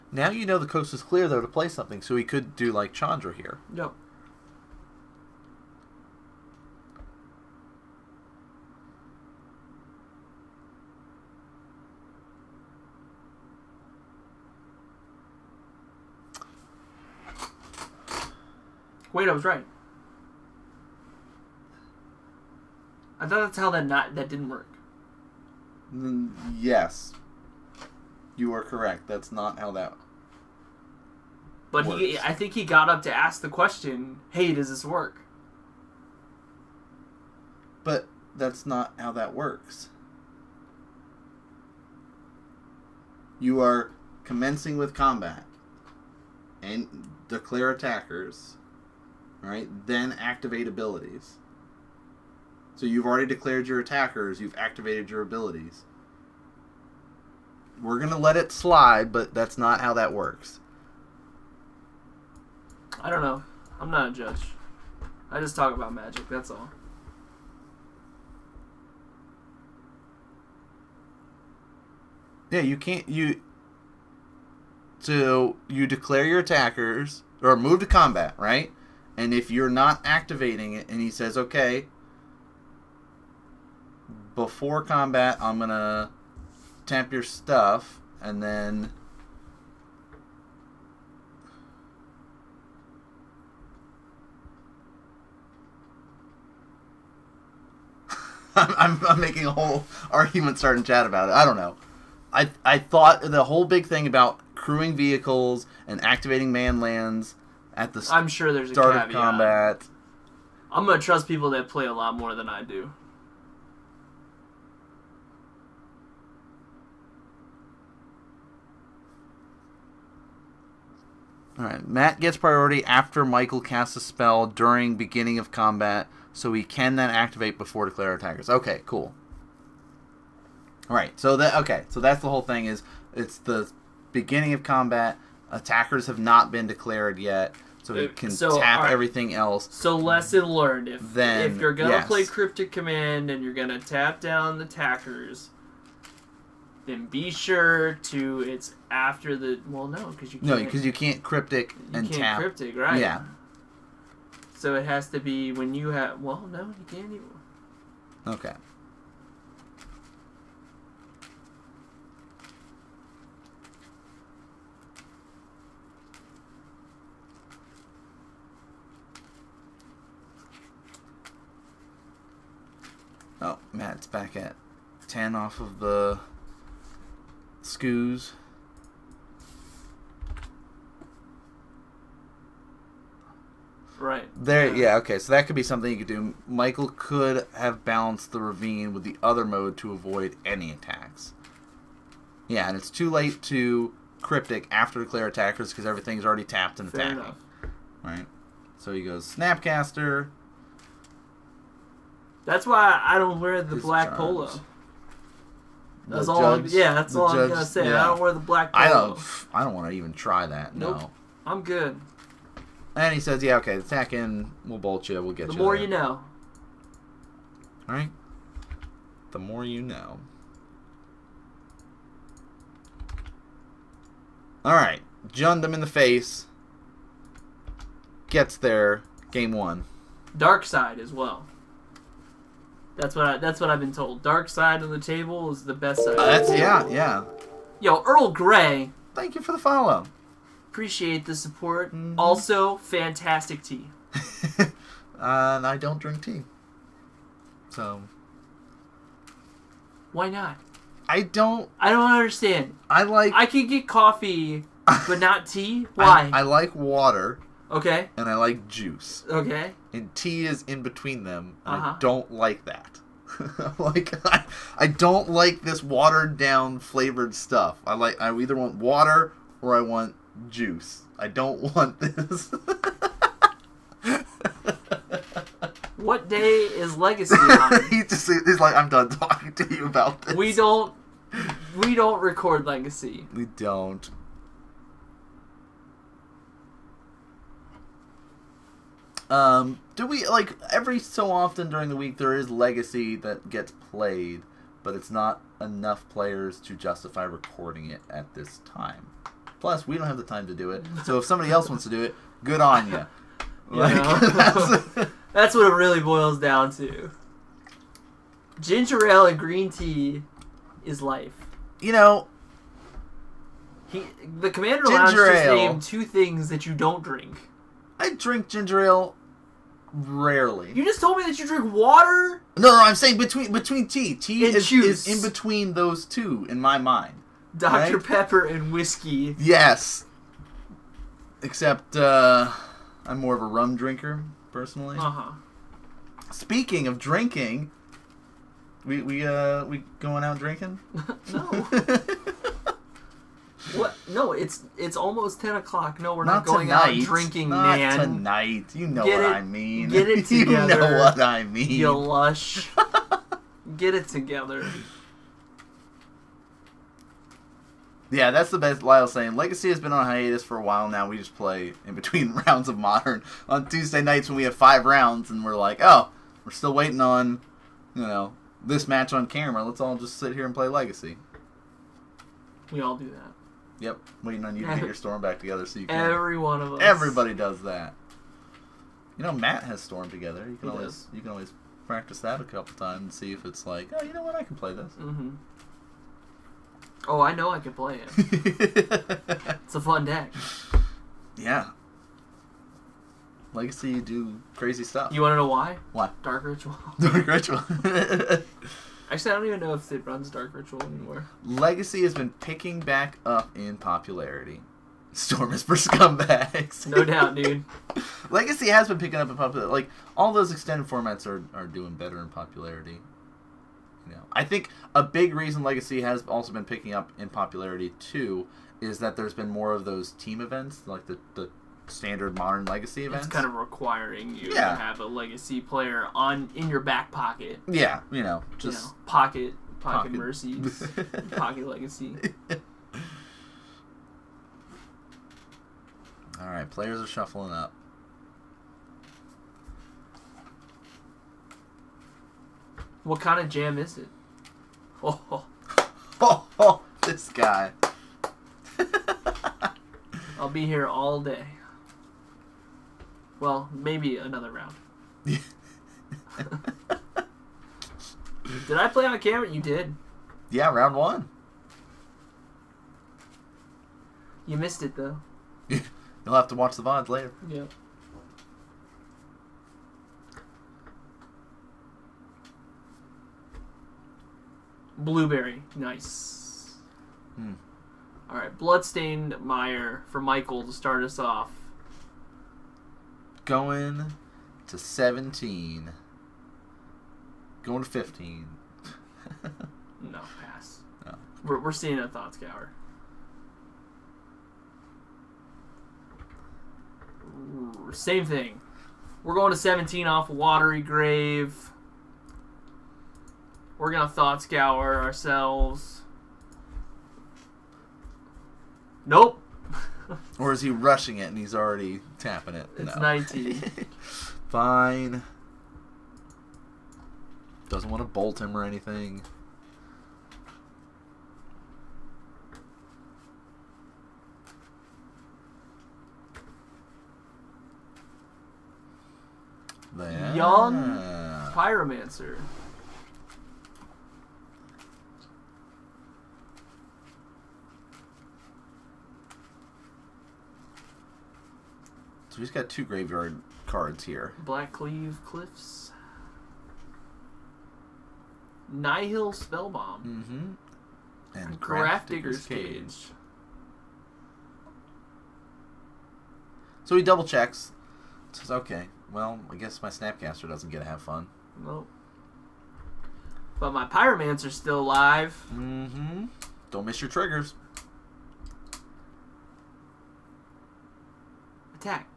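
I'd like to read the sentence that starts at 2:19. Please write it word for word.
So lesson learned: if then, if you're gonna yes.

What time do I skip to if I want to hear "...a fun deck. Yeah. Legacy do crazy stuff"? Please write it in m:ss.
6:29.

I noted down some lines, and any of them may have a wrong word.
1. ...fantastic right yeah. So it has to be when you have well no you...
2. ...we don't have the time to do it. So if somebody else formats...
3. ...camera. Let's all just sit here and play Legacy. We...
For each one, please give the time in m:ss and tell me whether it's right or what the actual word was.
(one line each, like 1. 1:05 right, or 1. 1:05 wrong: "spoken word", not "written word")
1. 2:32 wrong: "cryptic", not "fantastic"
2. 4:59 wrong: "wants", not "formats"
3. 6:09 right.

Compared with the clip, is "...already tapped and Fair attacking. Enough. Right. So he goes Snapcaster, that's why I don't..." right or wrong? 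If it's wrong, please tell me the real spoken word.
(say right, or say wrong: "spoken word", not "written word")
right.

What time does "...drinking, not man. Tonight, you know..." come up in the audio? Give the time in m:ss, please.
5:47.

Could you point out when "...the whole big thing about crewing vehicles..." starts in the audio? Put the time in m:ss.
1:43.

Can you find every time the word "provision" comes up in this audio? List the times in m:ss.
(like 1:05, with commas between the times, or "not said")
not said.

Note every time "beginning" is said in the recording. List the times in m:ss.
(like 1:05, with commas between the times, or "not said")
2:04, 2:14.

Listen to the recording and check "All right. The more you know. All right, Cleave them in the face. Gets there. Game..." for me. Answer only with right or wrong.
wrong.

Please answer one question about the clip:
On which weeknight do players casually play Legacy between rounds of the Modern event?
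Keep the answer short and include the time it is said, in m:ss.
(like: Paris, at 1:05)
Tuesday, at 6:03.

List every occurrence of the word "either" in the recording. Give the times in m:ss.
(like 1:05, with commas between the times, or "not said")
4:28.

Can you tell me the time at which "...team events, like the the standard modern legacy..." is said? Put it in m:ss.
7:00.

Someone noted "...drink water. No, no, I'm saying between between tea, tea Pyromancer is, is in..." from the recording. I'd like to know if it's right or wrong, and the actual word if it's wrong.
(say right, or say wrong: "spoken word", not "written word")
wrong: "And", not "Pyromancer".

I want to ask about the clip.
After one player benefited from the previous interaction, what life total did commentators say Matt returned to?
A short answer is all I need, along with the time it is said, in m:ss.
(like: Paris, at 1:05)
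10, at 2:55.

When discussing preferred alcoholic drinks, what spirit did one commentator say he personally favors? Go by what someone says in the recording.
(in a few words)
Rum.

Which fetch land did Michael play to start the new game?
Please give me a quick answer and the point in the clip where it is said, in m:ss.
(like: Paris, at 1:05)
Bloodstained Mire, at 7:58.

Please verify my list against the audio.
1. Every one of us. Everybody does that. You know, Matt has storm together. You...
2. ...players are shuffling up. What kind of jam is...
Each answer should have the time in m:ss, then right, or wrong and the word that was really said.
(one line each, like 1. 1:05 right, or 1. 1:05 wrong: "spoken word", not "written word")
1. 6:16 right
2. 7:16 right.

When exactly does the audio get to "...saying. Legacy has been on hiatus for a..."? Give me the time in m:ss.
5:59.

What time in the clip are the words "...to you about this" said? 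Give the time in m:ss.
4:39.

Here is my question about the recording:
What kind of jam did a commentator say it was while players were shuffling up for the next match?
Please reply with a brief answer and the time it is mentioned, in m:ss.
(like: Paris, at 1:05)
Blueberry, at 7:54.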